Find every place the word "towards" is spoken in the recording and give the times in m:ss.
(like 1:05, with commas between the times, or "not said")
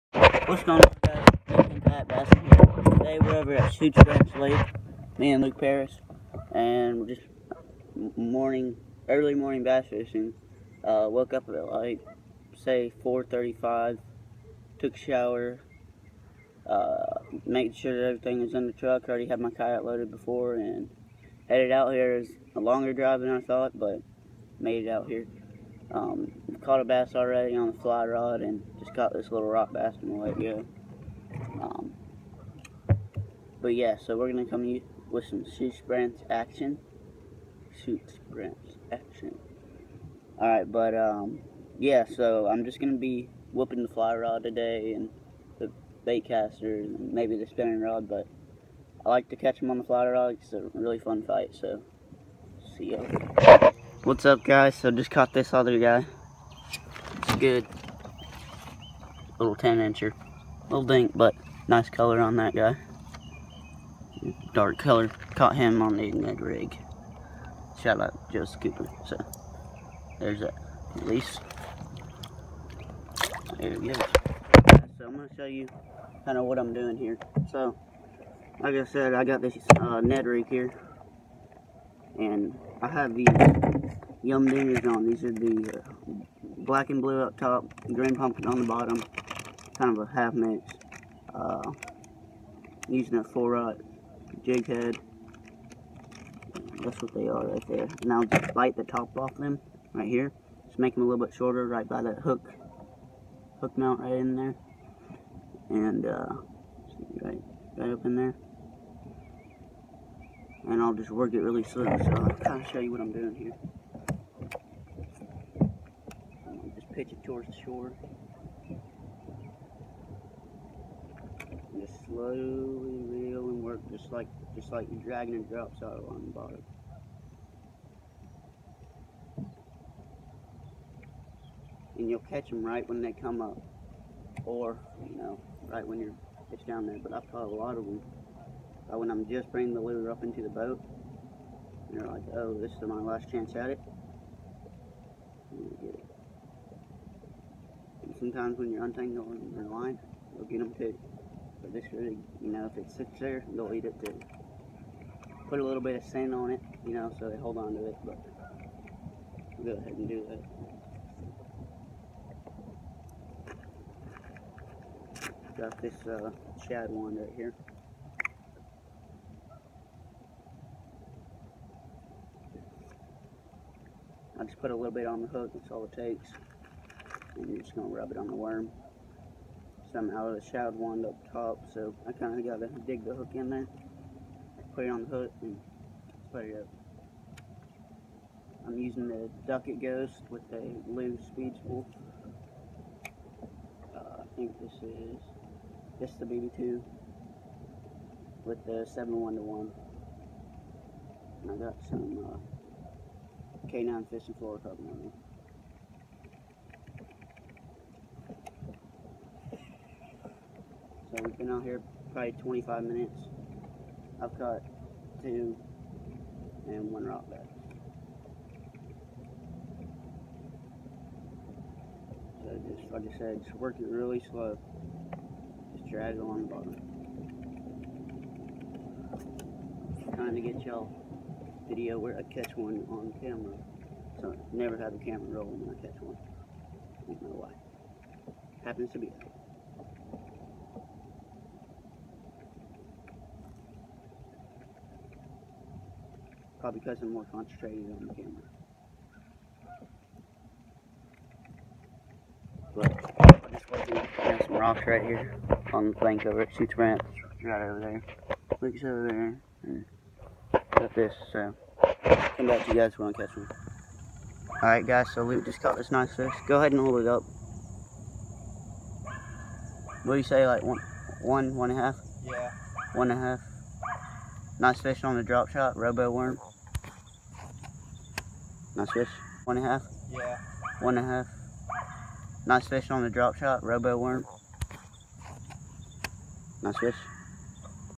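1:57.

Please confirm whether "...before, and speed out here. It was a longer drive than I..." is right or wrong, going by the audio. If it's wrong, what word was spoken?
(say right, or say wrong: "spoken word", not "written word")
wrong: "headed", not "speed".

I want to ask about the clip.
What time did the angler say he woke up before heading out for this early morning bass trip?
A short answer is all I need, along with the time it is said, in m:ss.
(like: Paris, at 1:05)
4:35, at 0:13.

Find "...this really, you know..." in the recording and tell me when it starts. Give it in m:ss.
2:31.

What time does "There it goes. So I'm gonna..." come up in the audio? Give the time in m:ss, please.
1:13.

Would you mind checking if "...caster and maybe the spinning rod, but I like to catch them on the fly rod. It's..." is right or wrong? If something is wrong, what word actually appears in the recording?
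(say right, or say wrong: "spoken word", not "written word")
right.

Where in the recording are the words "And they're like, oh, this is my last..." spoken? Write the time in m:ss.
2:21.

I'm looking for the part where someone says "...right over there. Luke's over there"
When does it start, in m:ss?
4:17.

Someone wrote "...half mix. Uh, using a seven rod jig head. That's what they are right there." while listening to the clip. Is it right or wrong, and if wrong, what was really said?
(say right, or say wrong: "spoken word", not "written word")
wrong: "four", not "seven".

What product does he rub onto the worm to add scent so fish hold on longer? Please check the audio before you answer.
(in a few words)
shad wand.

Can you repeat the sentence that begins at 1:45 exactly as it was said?
And uh, right, right up in there and I'll just work it really slow.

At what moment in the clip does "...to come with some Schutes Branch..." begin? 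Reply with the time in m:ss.
0:34.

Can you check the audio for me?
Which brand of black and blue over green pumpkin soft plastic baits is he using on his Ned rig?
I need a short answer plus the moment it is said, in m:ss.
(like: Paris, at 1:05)
YUM Dingers, at 1:24.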